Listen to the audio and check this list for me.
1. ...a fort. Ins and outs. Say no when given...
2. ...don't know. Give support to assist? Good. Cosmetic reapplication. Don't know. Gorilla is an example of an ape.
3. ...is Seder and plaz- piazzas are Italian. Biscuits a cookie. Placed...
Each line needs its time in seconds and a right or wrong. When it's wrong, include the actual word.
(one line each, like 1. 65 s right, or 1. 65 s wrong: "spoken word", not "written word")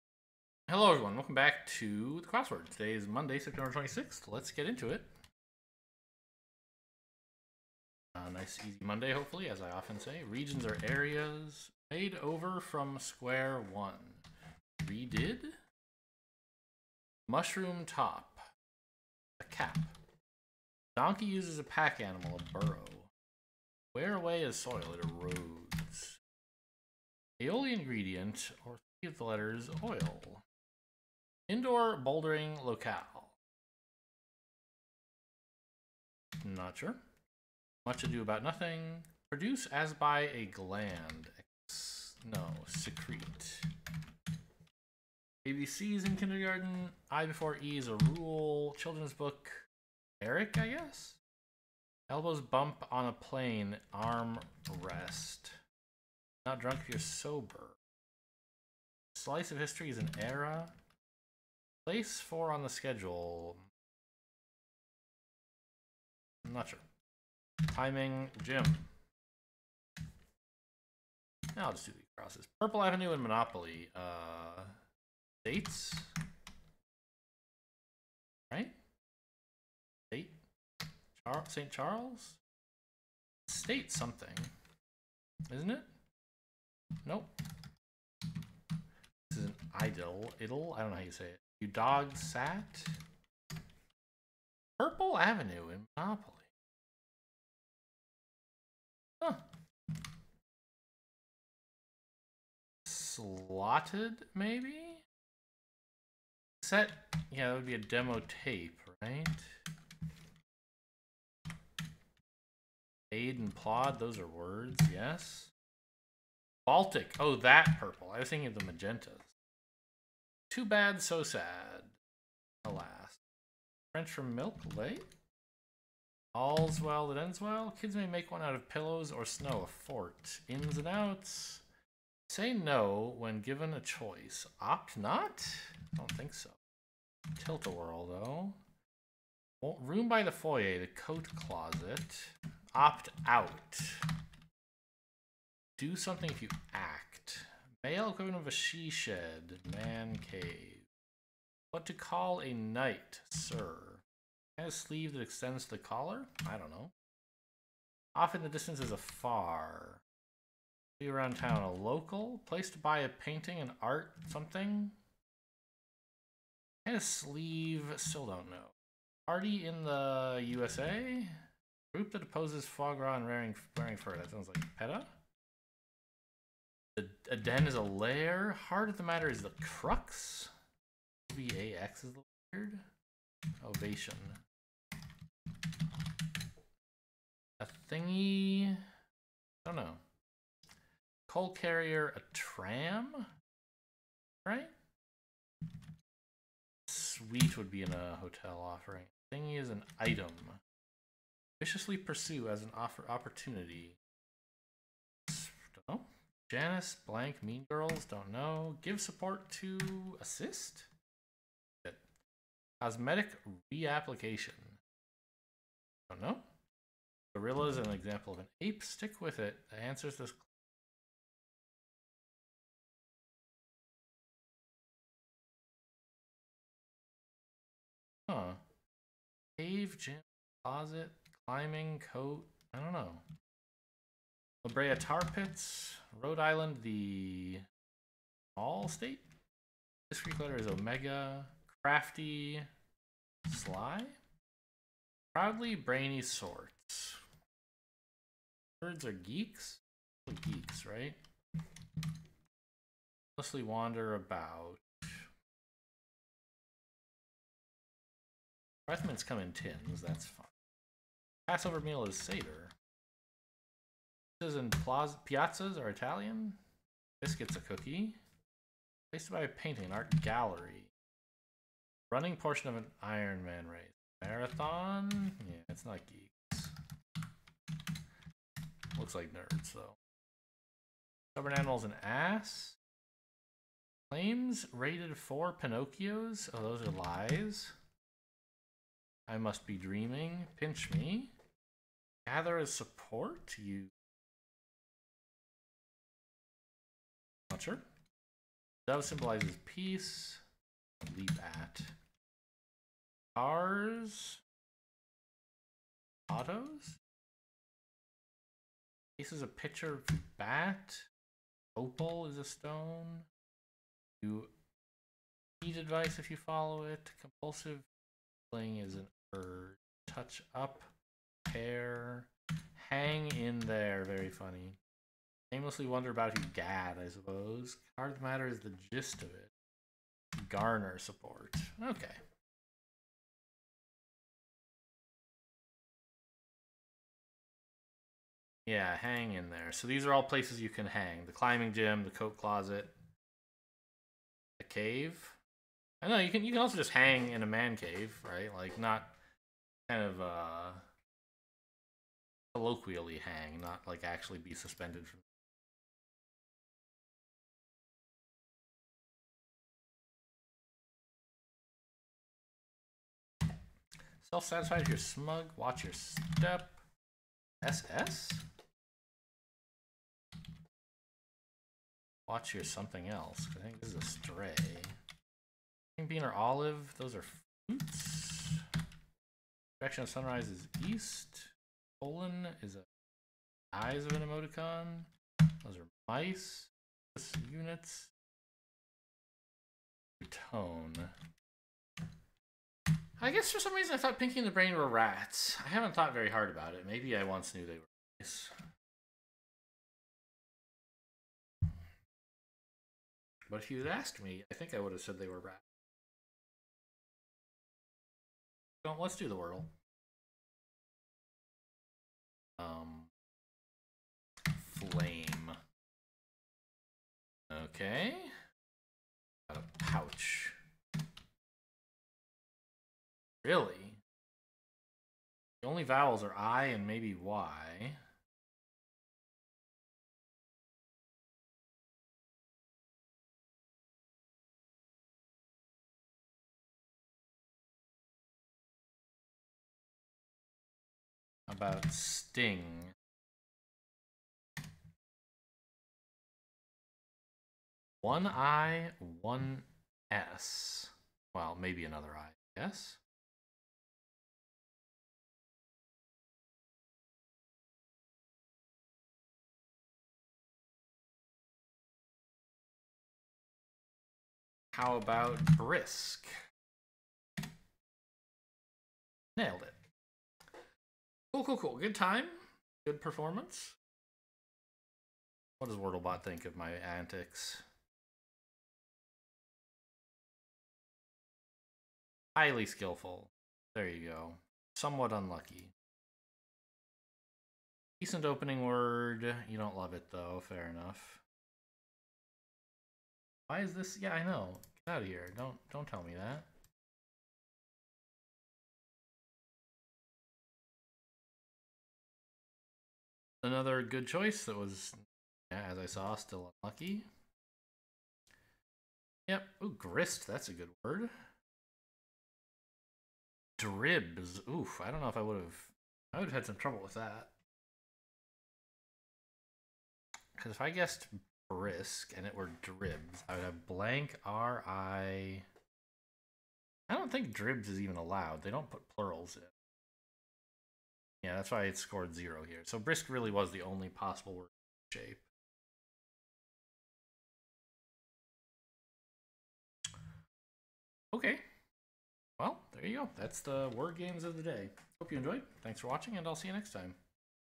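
1. 129 s right
2. 208 s right
3. 262 s right.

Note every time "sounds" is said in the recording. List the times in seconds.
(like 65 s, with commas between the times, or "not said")
174 s.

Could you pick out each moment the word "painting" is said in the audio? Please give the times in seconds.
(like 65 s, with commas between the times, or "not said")
163 s, 269 s.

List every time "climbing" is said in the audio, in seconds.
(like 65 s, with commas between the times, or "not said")
231 s, 341 s.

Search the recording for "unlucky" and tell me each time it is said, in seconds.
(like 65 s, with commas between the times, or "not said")
485 s, 506 s.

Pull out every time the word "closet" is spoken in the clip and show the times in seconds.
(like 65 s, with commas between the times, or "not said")
141 s, 230 s, 342 s.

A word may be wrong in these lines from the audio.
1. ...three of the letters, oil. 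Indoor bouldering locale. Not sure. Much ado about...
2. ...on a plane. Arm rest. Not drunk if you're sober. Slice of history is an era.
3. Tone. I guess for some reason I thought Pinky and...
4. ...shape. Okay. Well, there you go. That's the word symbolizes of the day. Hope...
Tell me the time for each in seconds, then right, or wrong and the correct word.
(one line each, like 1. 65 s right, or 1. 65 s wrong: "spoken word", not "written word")
1. 29 s right
2. 52 s right
3. 390 s right
4. 534 s wrong: "games", not "symbolizes".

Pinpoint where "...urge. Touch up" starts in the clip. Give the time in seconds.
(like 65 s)
319 s.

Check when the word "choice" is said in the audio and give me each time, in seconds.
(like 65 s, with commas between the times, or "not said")
133 s, 504 s.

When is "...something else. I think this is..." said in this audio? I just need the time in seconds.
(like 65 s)
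372 s.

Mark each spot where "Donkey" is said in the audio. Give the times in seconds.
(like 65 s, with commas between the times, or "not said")
20 s.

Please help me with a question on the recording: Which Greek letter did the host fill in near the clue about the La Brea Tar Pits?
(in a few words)
Omega.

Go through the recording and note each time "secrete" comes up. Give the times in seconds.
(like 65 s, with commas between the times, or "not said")
42 s.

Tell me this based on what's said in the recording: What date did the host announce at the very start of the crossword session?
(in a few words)
Monday, September 26th.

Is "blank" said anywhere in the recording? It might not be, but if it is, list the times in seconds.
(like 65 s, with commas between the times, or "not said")
207 s, 523 s.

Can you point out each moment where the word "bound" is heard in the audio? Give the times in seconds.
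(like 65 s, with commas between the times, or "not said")
not said.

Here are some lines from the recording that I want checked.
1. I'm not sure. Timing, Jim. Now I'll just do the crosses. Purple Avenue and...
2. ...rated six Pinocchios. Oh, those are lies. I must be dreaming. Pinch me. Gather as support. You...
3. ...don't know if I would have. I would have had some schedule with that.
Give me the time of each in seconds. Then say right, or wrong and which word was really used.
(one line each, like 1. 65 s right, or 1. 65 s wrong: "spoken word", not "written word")
1. 66 s right
2. 284 s wrong: "four", not "six"
3. 514 s wrong: "trouble", not "schedule".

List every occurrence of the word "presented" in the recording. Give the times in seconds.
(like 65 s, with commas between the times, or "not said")
not said.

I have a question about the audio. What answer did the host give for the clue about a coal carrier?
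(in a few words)
tram.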